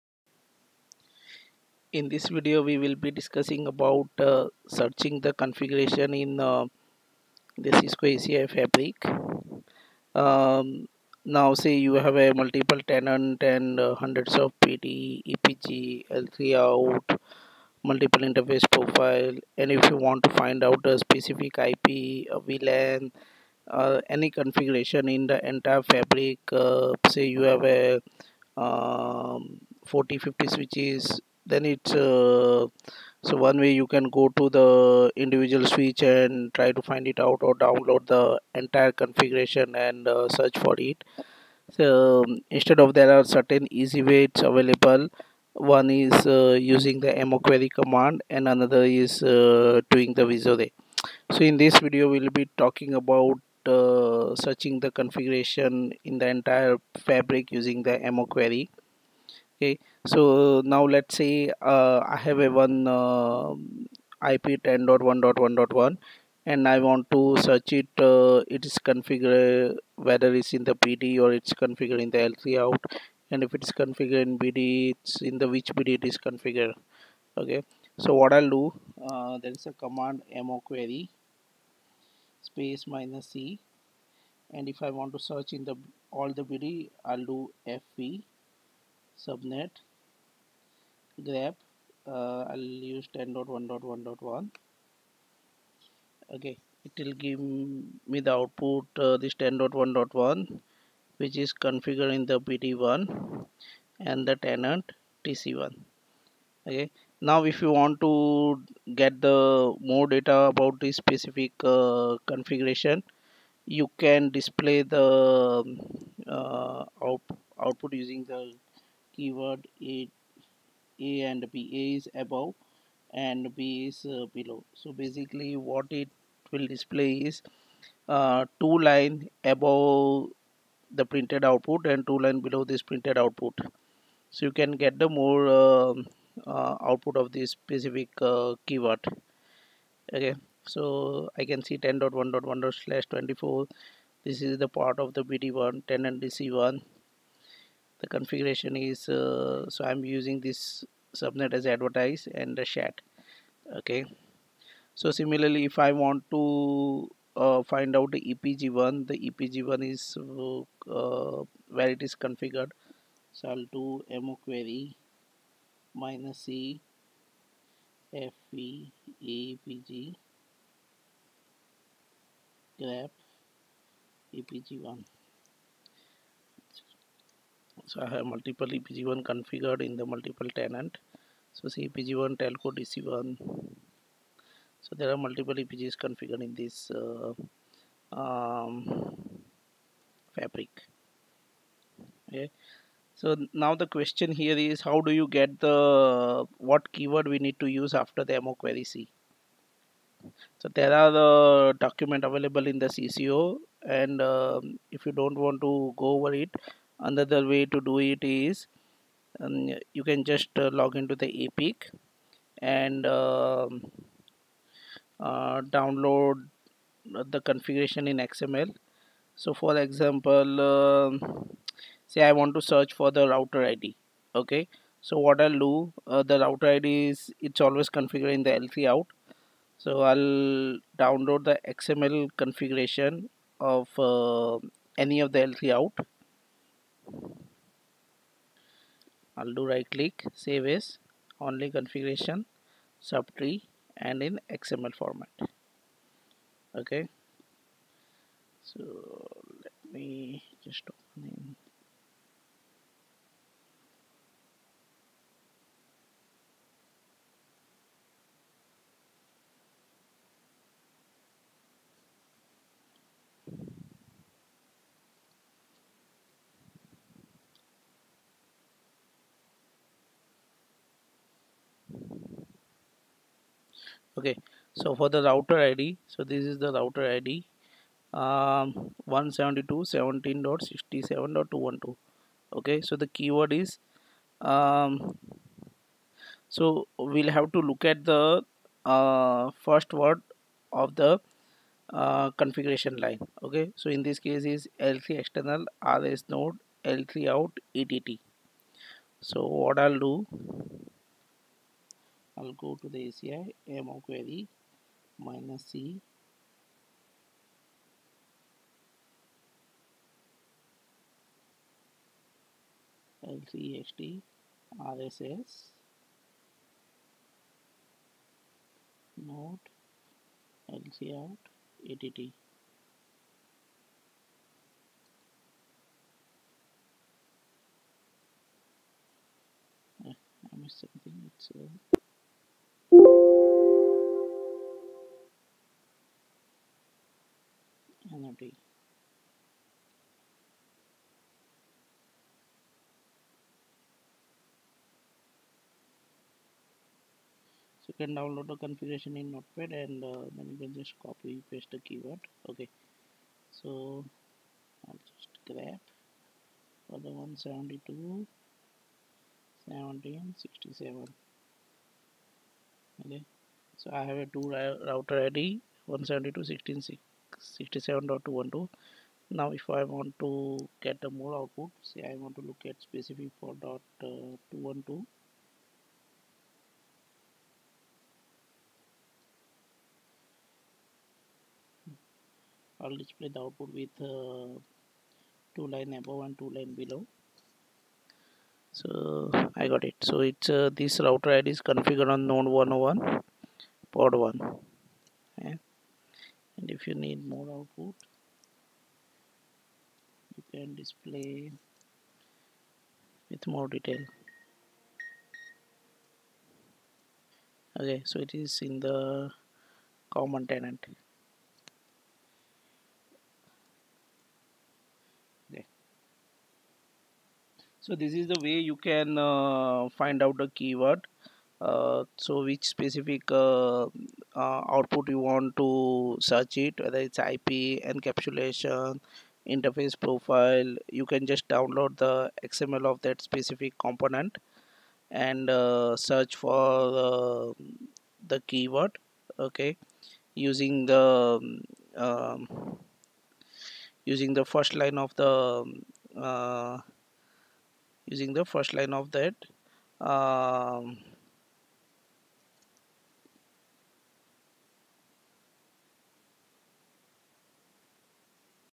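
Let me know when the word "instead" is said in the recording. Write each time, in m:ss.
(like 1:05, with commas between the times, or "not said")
0:42.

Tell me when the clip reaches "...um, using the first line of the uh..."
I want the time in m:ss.
7:21.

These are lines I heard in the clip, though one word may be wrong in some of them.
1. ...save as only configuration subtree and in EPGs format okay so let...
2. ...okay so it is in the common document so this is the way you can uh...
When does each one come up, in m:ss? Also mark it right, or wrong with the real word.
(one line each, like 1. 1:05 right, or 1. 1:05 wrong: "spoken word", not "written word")
1. 4:00 wrong: "XML", not "EPGs"
2. 6:47 wrong: "tenant", not "document".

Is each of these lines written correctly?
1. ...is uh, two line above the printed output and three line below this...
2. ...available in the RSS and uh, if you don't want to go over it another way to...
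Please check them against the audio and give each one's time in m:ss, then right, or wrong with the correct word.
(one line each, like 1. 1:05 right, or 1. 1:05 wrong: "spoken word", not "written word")
1. 2:07 wrong: "two", not "three"
2. 3:22 wrong: "CCO", not "RSS".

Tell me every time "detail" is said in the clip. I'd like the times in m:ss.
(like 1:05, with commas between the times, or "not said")
6:43.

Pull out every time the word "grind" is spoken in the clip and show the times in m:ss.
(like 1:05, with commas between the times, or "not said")
not said.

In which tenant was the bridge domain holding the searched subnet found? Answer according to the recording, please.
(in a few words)
TC1.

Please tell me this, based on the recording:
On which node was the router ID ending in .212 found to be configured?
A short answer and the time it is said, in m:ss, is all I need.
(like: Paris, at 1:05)
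node 101, at 6:32.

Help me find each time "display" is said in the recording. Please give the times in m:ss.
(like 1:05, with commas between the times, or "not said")
1:54, 2:06, 6:23, 6:40.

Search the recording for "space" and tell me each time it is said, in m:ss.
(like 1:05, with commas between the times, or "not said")
1:22.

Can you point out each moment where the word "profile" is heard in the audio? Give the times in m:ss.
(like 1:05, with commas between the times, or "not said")
0:18, 7:09.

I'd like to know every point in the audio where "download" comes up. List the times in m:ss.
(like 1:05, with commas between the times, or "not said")
0:37, 3:35, 3:51, 5:48, 7:11.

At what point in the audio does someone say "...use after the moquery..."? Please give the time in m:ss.
3:17.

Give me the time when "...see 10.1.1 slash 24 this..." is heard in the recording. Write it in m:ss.
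2:21.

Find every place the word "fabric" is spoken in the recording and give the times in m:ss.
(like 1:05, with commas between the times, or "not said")
0:08, 0:25, 0:57, 3:10.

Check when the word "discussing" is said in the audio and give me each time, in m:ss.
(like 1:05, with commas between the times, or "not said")
0:03.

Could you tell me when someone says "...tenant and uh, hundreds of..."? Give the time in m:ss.
0:12.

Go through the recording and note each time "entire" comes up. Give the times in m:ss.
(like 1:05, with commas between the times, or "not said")
0:25, 0:38, 0:56.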